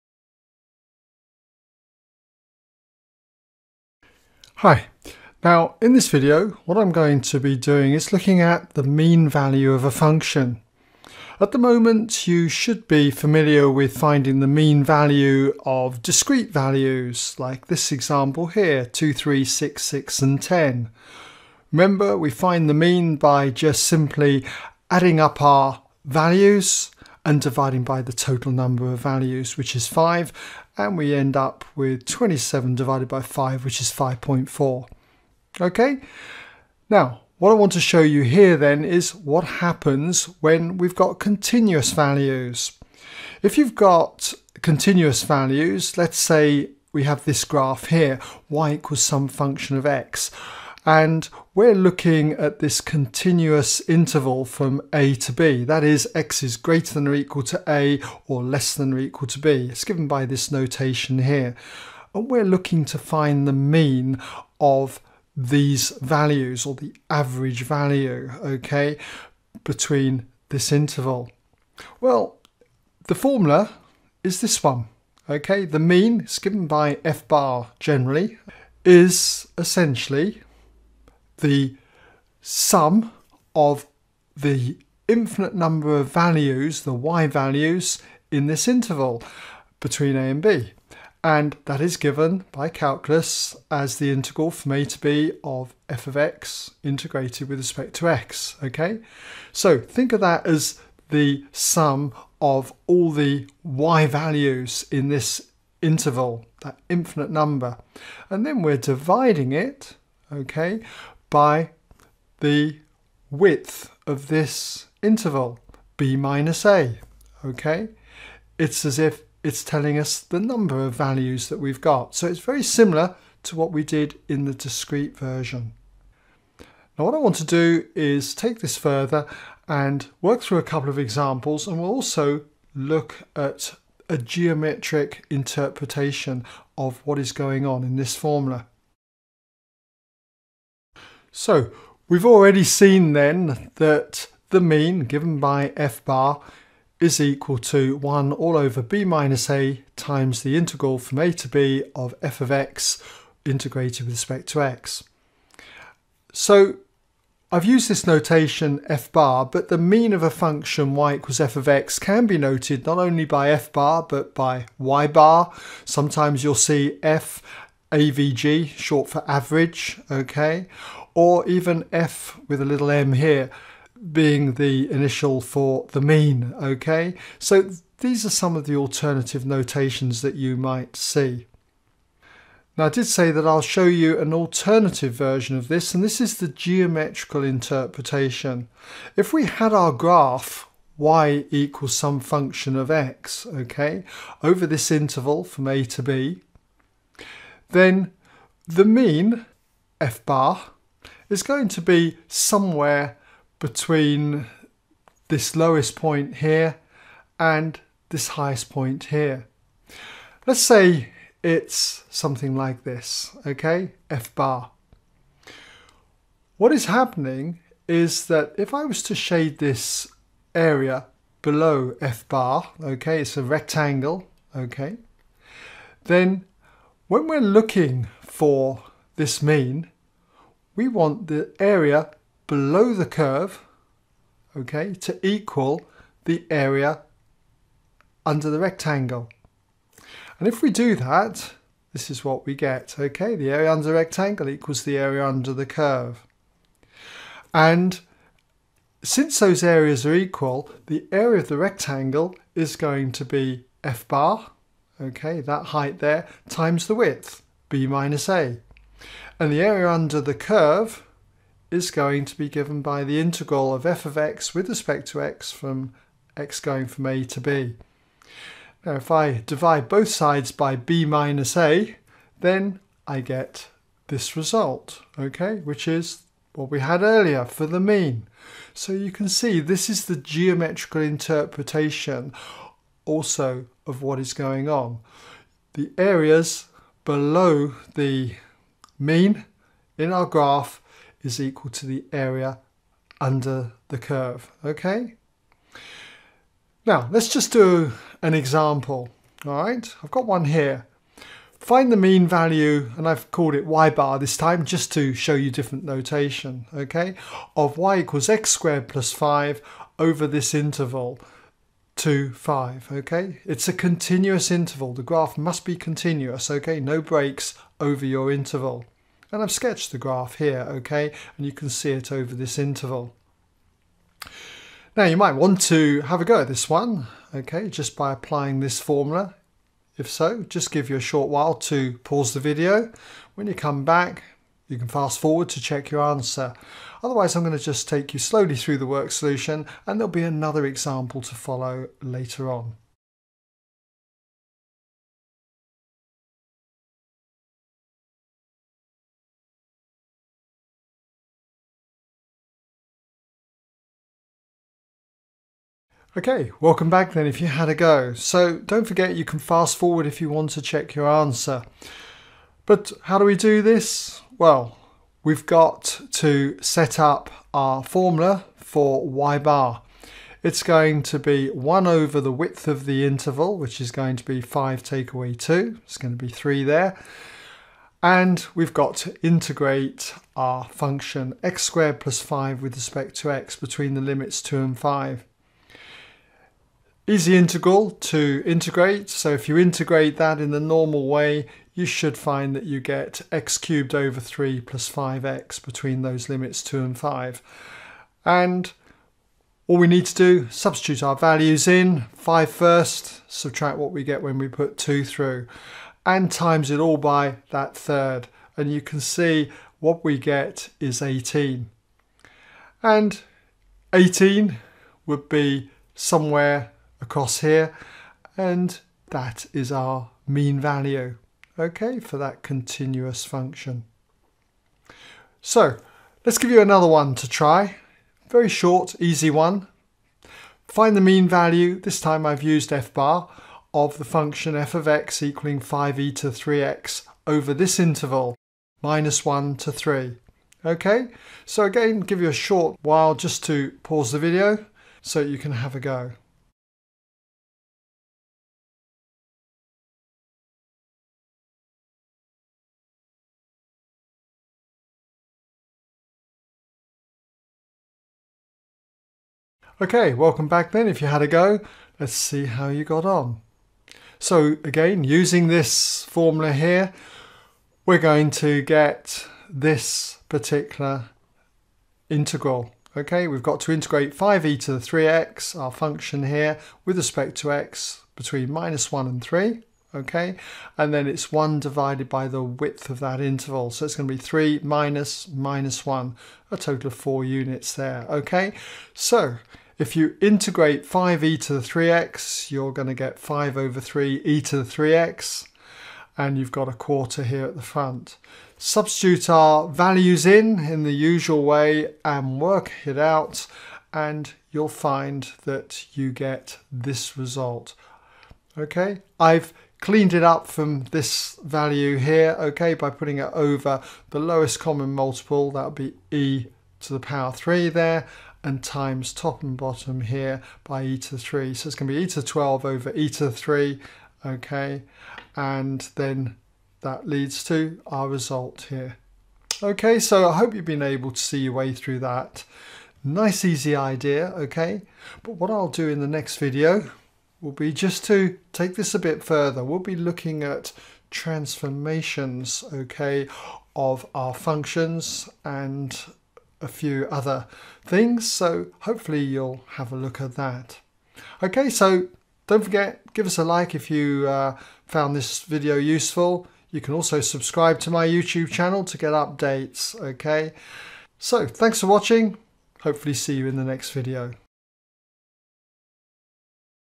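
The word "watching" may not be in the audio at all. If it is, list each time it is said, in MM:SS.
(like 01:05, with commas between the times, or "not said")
09:21.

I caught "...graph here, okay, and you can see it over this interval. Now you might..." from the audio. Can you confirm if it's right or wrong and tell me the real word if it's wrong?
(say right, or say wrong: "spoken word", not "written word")
right.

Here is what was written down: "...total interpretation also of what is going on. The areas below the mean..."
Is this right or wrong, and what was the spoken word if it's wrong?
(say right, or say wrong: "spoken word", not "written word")
wrong: "geometrical", not "total".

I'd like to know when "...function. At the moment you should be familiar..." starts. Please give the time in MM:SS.
00:09.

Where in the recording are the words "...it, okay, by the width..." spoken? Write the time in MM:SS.
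01:49.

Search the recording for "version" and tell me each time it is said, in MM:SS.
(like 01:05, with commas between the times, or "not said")
02:05, 03:05.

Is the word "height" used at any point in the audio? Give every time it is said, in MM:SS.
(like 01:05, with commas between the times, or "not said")
04:15.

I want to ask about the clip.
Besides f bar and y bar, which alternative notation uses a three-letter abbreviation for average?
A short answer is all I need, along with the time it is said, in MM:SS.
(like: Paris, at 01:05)
f AVG, at 02:47.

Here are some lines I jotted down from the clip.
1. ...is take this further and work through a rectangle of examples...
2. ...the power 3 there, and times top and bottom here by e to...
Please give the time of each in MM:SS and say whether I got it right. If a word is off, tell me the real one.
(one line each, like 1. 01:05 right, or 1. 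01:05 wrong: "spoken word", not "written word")
1. 02:07 wrong: "couple", not "rectangle"
2. 08:36 right.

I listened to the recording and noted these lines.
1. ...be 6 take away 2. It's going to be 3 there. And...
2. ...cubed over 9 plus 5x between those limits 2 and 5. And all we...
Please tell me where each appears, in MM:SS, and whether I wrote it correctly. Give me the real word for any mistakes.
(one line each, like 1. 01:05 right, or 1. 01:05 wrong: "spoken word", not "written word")
1. 06:14 wrong: "5", not "6"
2. 06:33 wrong: "3", not "9".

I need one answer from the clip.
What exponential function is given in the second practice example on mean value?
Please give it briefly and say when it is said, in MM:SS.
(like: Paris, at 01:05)
5e to 3x, at 07:15.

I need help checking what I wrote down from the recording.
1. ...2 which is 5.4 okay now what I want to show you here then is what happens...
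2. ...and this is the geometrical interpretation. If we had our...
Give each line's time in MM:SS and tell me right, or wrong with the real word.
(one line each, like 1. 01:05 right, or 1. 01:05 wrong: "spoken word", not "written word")
1. 00:33 wrong: "5", not "2"
2. 03:05 right.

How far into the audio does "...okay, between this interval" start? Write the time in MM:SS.
01:08.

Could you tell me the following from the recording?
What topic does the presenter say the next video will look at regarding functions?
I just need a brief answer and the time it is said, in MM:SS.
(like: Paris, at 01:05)
transformations, at 09:01.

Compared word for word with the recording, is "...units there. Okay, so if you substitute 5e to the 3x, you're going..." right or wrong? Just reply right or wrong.
wrong.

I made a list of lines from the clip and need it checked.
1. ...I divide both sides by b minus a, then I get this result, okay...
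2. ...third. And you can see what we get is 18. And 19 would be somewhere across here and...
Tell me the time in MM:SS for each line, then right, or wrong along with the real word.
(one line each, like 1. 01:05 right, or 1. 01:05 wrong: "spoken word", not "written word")
1. 04:29 right
2. 06:47 wrong: "18", not "19".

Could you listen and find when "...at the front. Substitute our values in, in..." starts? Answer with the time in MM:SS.
08:17.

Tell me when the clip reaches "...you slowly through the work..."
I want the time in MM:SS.
05:38.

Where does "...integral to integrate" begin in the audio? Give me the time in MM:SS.
06:27.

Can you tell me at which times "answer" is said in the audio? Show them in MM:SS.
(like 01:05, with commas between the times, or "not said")
05:36, 06:01.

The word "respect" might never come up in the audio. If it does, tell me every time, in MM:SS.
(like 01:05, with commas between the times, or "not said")
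01:37, 02:34, 04:24, 06:22, 07:56.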